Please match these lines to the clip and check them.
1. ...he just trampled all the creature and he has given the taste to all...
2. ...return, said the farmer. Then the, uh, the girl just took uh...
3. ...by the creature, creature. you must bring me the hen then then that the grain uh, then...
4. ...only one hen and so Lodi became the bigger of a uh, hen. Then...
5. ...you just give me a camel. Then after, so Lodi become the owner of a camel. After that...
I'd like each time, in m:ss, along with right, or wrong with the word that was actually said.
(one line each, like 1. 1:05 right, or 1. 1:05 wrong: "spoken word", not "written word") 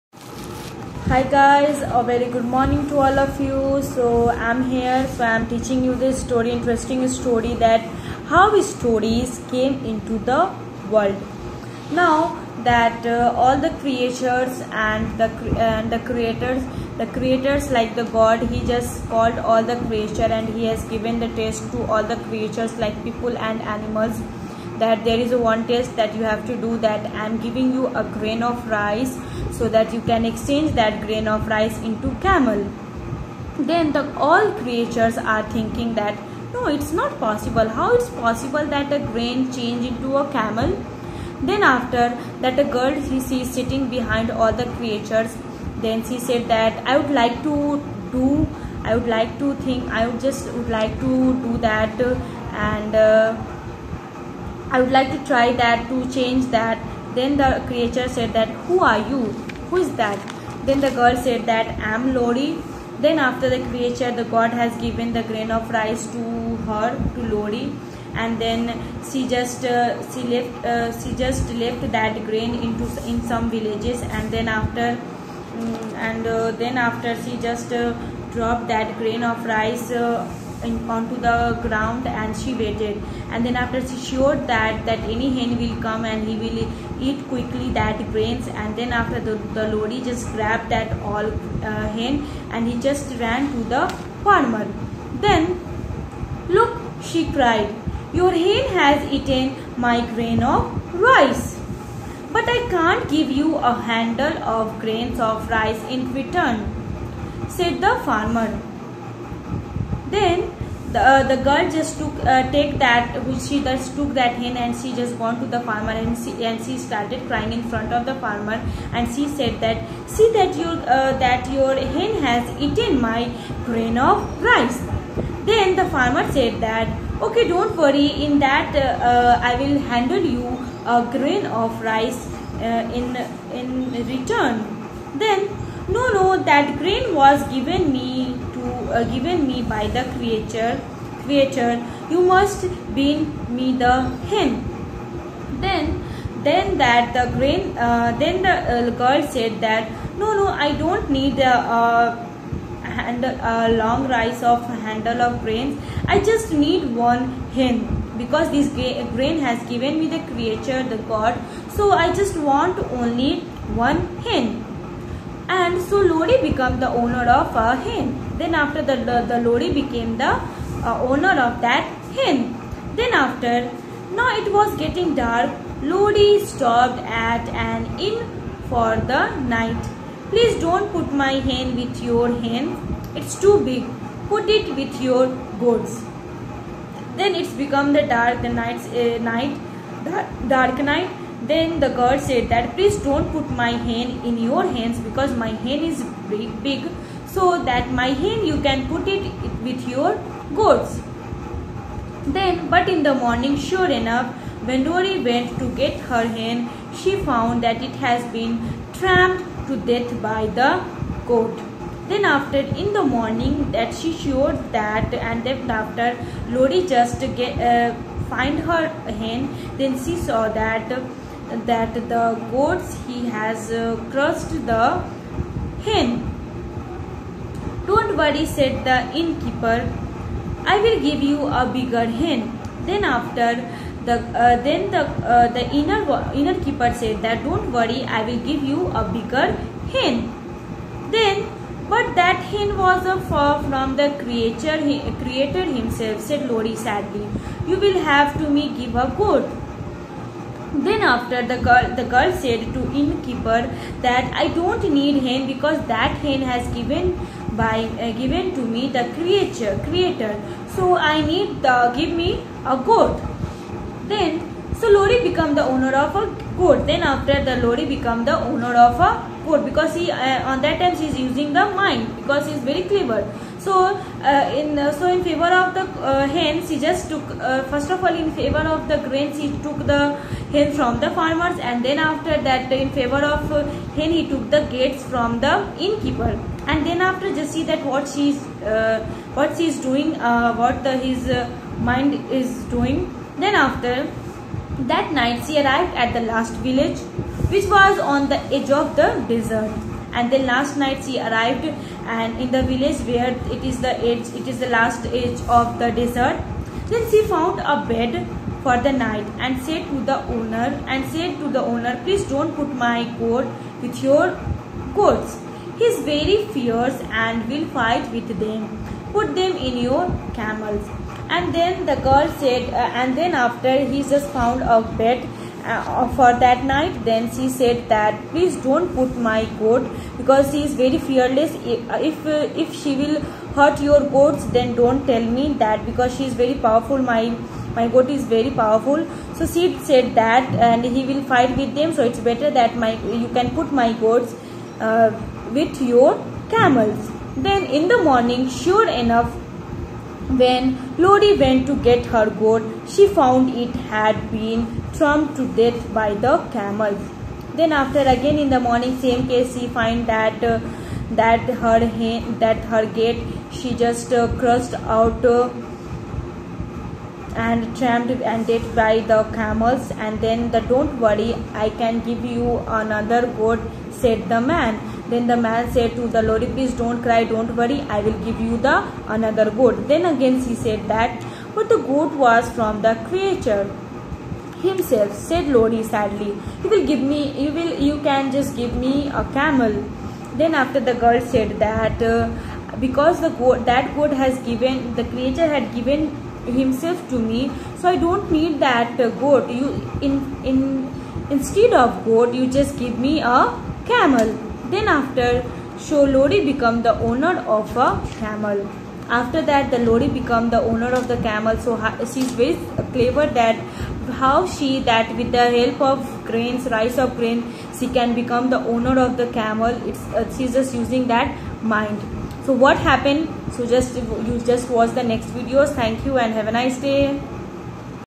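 1. 0:18 wrong: "called", not "trampled"
2. 1:46 right
3. 2:19 right
4. 2:43 wrong: "owner", not "bigger"
5. 6:42 right.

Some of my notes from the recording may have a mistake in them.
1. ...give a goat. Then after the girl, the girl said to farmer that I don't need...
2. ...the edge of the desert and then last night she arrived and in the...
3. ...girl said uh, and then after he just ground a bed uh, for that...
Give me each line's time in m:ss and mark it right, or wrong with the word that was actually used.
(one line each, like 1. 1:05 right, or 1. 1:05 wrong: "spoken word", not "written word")
1. 4:08 wrong: "innkeeper", not "farmer"
2. 4:58 right
3. 5:22 wrong: "found", not "ground".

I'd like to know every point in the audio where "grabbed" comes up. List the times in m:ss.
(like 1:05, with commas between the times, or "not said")
1:30.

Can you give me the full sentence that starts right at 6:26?
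You will give me, you will, you can just give me a camel.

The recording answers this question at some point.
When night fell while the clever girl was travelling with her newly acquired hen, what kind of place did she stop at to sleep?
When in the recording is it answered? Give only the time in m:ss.
2:57.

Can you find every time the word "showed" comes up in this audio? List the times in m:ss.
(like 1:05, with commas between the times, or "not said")
1:23, 3:34.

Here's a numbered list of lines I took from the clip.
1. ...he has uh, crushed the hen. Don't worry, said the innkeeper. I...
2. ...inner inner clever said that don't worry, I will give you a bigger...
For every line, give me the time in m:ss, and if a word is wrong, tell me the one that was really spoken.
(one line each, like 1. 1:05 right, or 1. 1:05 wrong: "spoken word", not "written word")
1. 3:43 right
2. 3:55 wrong: "keeper", not "clever".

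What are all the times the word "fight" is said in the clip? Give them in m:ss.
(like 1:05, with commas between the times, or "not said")
5:17, 5:41.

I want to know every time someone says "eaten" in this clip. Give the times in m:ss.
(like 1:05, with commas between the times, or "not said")
1:39, 2:02.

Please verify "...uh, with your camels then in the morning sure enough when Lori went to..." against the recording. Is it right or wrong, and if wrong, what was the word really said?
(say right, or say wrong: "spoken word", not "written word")
right.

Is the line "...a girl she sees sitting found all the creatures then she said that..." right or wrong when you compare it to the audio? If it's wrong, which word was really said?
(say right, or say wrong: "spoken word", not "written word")
wrong: "behind", not "found".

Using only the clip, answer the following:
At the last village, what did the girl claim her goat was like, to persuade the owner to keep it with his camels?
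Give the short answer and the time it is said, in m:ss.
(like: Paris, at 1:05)
very fierce, at 5:16.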